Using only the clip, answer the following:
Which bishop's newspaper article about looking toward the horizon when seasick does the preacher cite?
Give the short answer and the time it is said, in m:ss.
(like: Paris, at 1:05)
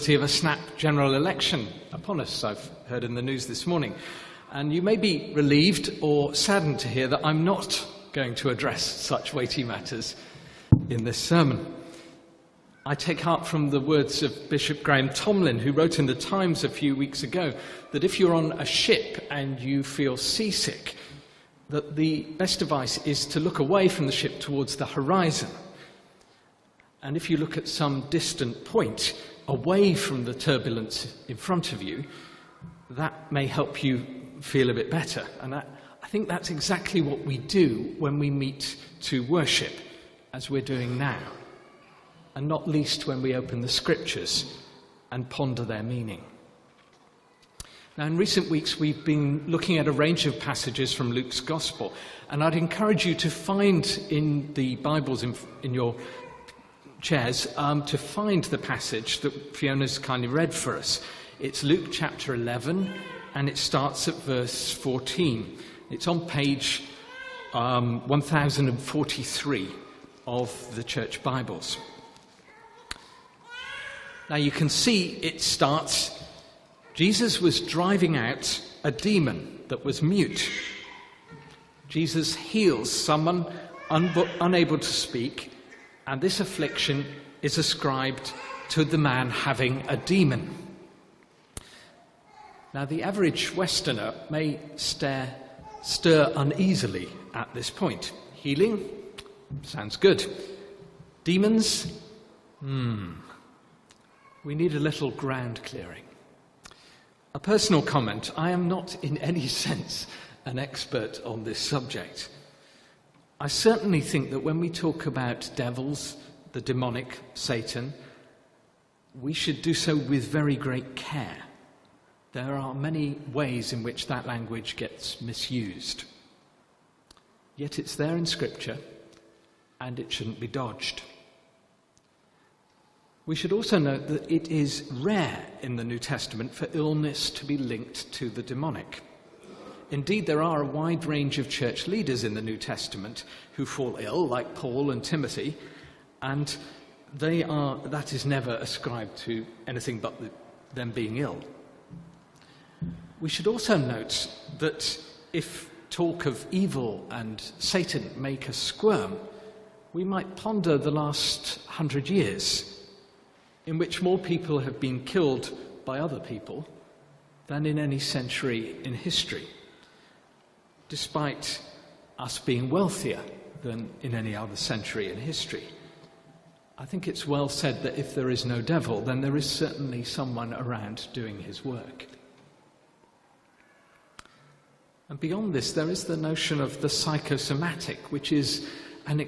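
Graham Tomlin, at 0:14.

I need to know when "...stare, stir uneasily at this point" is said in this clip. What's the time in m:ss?
1:34.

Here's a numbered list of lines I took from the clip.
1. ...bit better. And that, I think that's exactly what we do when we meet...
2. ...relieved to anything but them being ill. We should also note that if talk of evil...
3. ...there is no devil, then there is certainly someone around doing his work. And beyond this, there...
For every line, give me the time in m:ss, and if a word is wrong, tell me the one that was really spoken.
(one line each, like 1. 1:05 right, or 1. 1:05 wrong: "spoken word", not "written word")
1. 0:34 right
2. 2:28 wrong: "ascribed", not "relieved"
3. 2:58 right.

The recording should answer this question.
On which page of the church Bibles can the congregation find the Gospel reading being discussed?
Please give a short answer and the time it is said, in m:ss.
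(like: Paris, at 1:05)
1043, at 1:08.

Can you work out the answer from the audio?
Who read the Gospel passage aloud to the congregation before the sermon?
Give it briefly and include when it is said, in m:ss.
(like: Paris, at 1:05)
Fiona, at 0:59.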